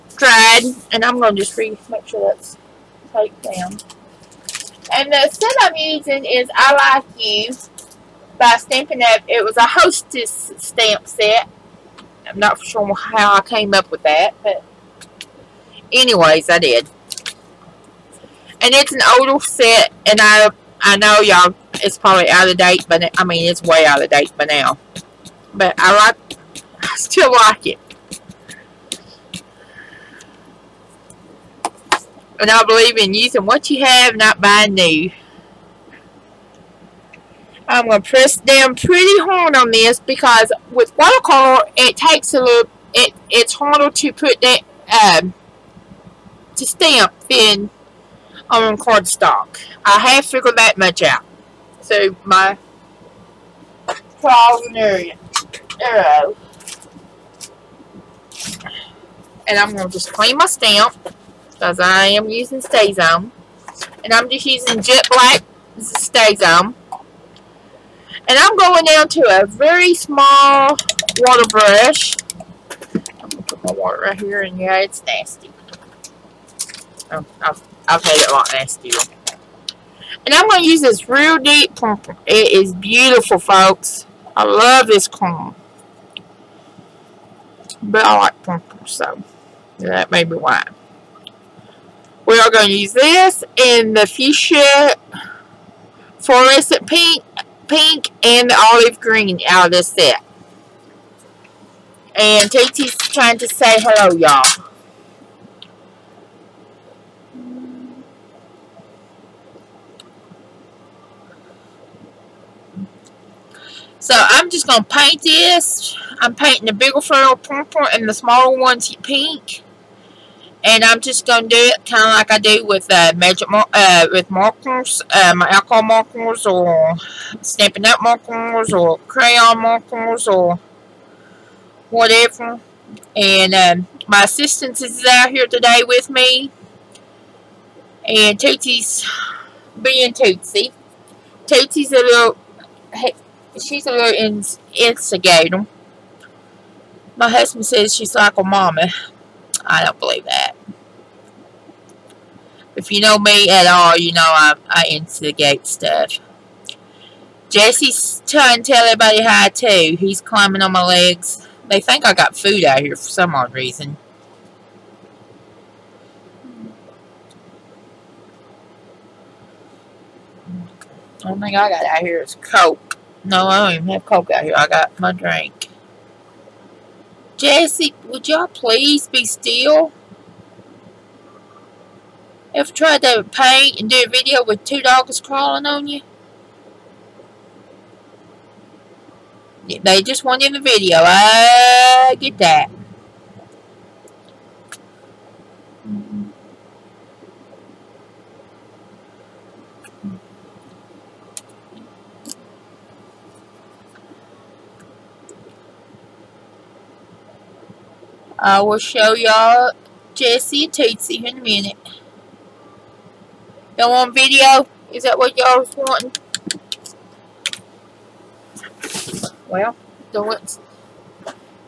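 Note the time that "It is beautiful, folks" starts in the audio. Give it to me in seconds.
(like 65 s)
82 s.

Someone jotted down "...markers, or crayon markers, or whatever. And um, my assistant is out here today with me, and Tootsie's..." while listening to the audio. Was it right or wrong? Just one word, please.
right.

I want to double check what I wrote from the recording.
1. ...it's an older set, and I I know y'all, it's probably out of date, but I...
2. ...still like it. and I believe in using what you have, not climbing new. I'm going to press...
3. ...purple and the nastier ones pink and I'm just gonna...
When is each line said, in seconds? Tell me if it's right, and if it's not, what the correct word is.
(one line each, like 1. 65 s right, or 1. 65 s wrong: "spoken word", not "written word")
1. 18 s right
2. 26 s wrong: "buying", not "climbing"
3. 117 s wrong: "smaller", not "nastier".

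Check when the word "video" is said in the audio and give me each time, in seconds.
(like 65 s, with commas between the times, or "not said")
184 s, 190 s, 214 s.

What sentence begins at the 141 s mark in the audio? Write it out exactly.
Tootsie's a little, she's a little in instigator.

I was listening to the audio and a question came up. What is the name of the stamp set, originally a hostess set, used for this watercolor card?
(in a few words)
I Like You.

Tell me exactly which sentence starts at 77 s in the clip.
Oh, I've, I've had it a lot nastier.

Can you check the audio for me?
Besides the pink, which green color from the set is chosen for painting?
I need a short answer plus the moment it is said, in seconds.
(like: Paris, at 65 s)
olive green, at 98 s.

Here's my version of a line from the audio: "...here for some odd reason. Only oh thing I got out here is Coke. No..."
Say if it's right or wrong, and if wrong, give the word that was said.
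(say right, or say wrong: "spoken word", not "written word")
right.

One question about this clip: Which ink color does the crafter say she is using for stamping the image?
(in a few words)
Jet Black.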